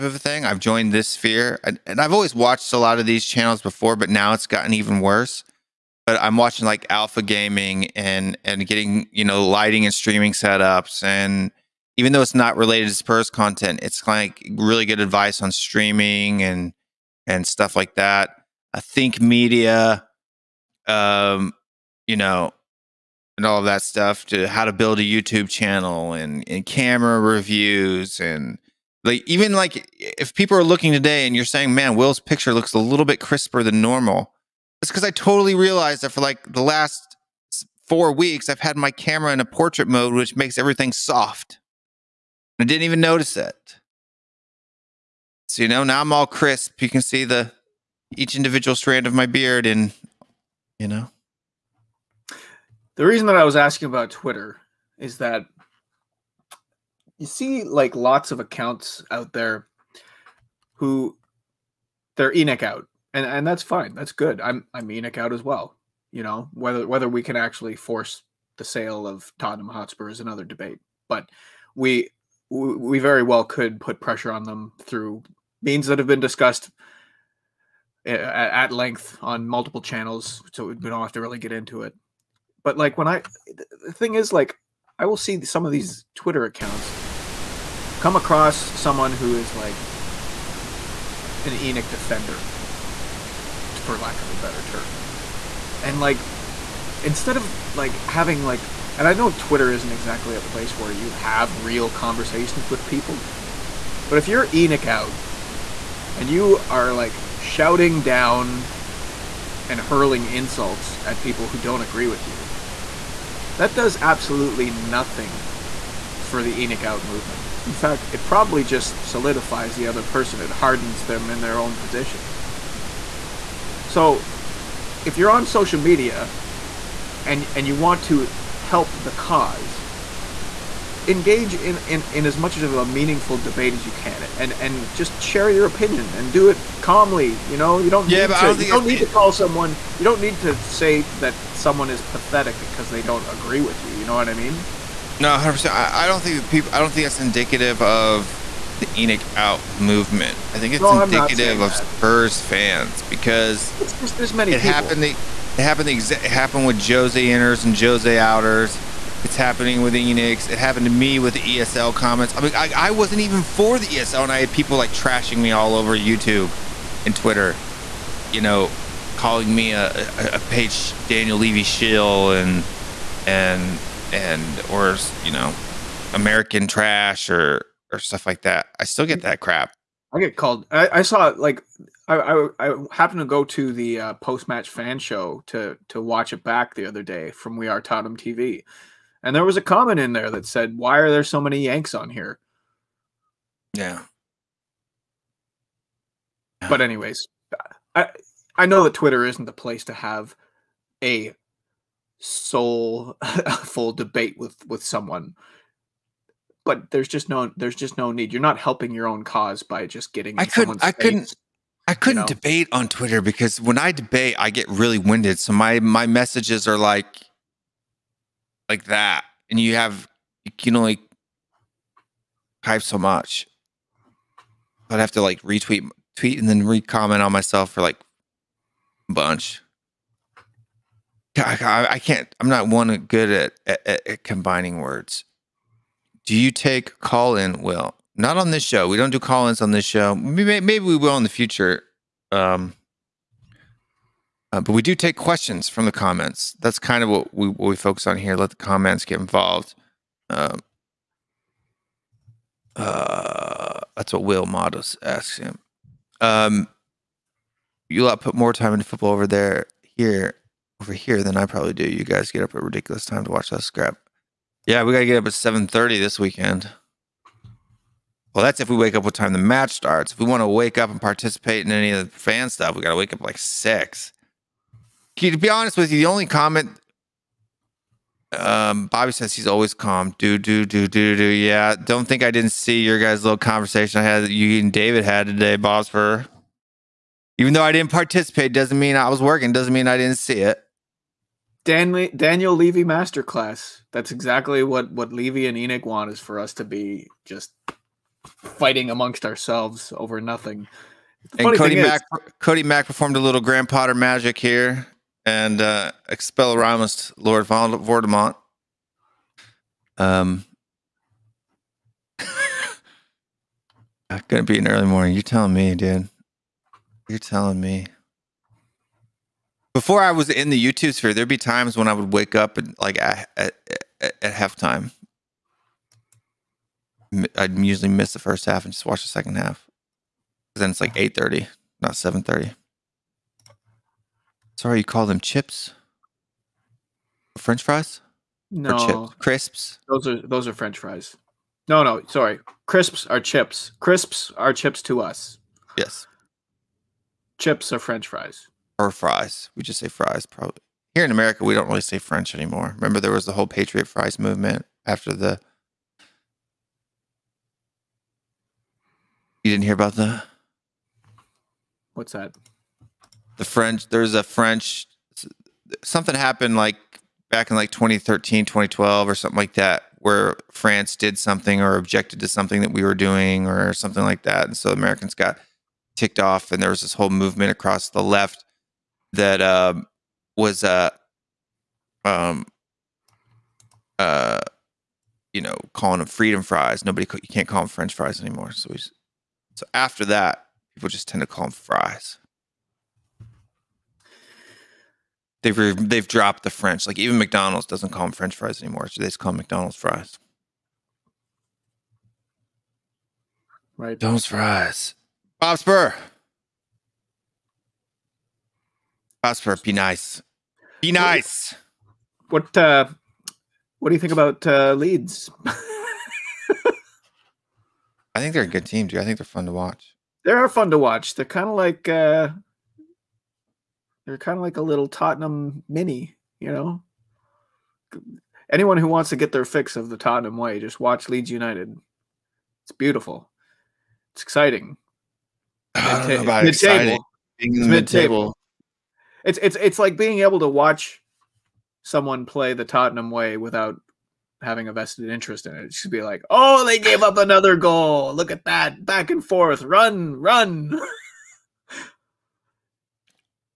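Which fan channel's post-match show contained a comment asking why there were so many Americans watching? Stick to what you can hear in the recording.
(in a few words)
We Are Tottenham TV.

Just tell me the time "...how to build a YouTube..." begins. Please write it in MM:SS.
00:24.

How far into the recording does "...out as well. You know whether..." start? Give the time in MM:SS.
01:05.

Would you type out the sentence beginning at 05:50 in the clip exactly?
Here in America, we don't really say French anymore.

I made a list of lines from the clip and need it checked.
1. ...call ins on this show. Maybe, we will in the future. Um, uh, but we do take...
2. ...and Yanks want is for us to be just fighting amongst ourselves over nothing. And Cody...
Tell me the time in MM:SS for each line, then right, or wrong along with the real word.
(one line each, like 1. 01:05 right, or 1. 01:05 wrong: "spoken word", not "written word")
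1. 03:59 right
2. 04:55 wrong: "ENIC", not "Yanks".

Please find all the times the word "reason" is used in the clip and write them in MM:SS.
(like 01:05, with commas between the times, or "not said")
00:53.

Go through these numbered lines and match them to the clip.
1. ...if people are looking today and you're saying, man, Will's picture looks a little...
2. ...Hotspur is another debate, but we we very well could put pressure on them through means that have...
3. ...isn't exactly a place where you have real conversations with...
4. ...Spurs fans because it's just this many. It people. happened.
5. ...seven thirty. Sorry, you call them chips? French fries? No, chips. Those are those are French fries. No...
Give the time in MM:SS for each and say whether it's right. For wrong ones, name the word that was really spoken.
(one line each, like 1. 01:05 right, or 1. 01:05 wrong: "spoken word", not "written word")
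1. 00:29 right
2. 01:09 right
3. 01:39 right
4. 02:31 right
5. 05:31 wrong: "crisps", not "chips".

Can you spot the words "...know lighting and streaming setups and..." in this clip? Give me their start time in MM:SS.
00:09.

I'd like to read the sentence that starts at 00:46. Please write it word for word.
You can see the each individual strand of my beard and, you know.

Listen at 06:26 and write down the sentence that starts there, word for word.
Nobody you can't call them French fries anymore.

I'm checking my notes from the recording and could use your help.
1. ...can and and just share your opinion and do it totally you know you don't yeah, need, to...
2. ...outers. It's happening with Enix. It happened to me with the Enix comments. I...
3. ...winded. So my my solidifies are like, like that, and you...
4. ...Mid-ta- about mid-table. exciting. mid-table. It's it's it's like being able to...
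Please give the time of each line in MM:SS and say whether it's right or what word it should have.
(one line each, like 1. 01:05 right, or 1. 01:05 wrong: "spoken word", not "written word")
1. 02:13 wrong: "calmly", not "totally"
2. 02:38 wrong: "ESL", not "Enix"
3. 03:34 wrong: "messages", not "solidifies"
4. 07:15 right.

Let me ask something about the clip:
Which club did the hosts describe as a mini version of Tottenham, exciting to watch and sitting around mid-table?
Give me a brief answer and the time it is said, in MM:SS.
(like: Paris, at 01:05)
Leeds United, at 07:11.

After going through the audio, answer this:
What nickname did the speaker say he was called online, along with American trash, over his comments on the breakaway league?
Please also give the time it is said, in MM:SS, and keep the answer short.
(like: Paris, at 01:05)
Daniel Levy shill, at 02:51.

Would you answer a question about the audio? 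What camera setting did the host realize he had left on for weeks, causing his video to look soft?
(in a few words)
portrait mode.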